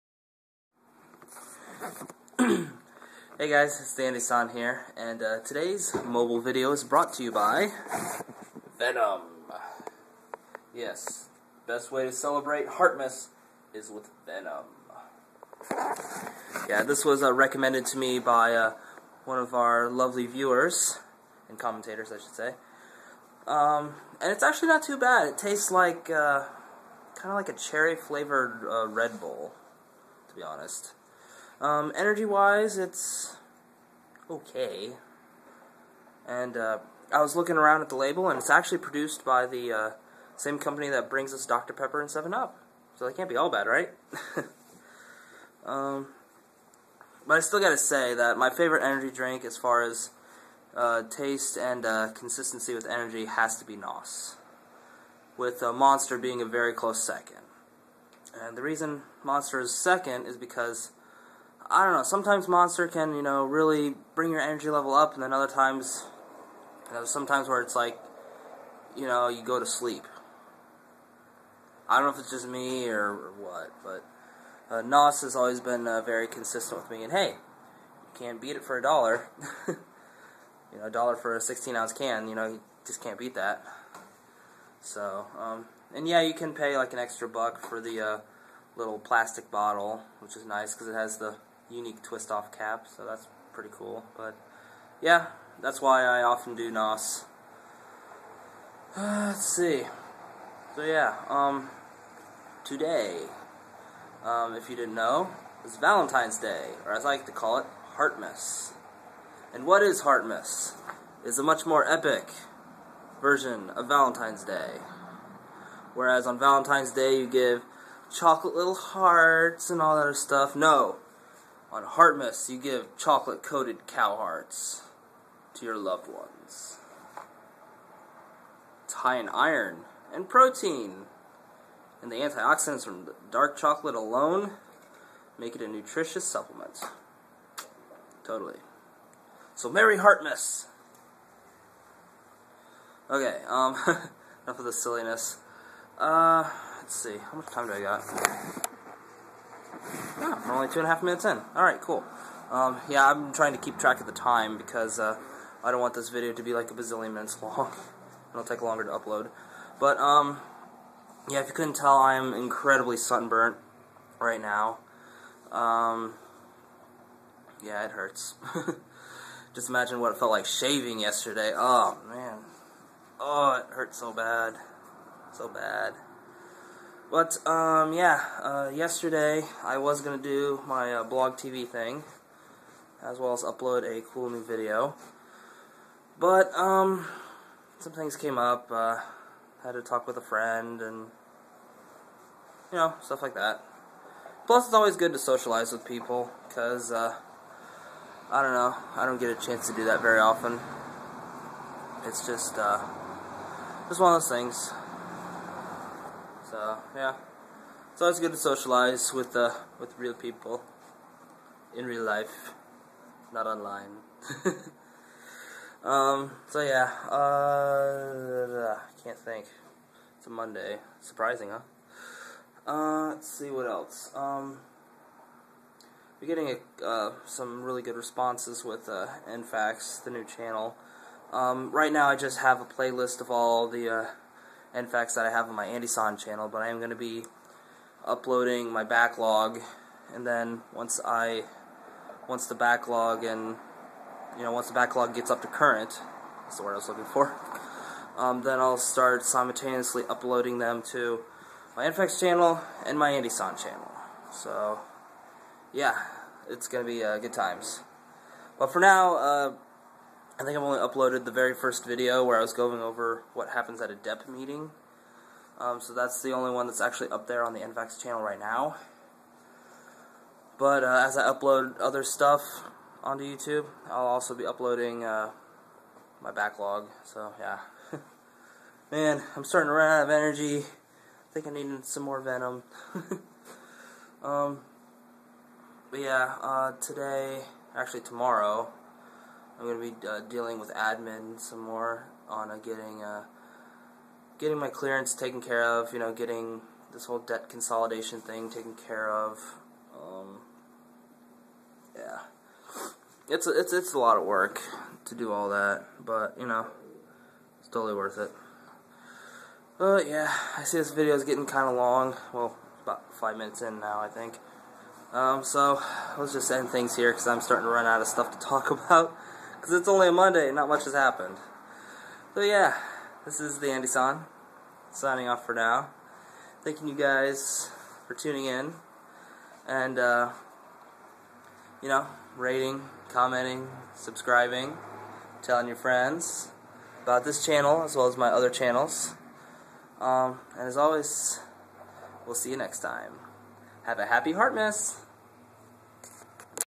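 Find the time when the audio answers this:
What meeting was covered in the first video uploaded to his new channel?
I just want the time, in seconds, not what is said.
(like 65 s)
263 s.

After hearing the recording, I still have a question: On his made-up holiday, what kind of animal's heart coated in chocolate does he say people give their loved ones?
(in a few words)
Cow.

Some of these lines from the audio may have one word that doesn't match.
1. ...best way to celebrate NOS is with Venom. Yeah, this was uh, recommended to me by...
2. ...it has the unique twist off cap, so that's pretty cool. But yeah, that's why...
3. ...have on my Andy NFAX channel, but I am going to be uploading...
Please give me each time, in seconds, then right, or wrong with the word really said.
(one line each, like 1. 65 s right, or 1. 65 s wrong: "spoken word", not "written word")
1. 11 s wrong: "Heartmas", not "NOS"
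2. 90 s right
3. 235 s wrong: "San", not "NFAX".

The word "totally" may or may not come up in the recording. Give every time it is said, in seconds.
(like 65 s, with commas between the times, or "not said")
138 s, 307 s.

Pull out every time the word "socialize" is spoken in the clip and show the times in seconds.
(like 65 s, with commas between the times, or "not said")
195 s, 208 s.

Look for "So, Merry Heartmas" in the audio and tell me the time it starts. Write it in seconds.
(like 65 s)
139 s.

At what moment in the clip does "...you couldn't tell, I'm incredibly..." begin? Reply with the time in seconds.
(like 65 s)
161 s.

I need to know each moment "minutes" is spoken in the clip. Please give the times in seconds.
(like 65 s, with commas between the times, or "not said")
151 s, 157 s, 313 s.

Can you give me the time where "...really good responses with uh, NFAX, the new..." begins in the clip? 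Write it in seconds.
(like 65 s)
227 s.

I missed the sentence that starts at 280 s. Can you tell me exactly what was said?
I think I need some more Venom.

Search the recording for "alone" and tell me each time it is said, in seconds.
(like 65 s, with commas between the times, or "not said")
133 s.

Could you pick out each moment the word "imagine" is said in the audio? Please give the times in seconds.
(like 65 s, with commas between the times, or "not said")
169 s.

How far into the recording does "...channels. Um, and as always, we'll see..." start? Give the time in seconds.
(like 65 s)
338 s.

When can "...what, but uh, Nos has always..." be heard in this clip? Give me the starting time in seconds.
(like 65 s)
73 s.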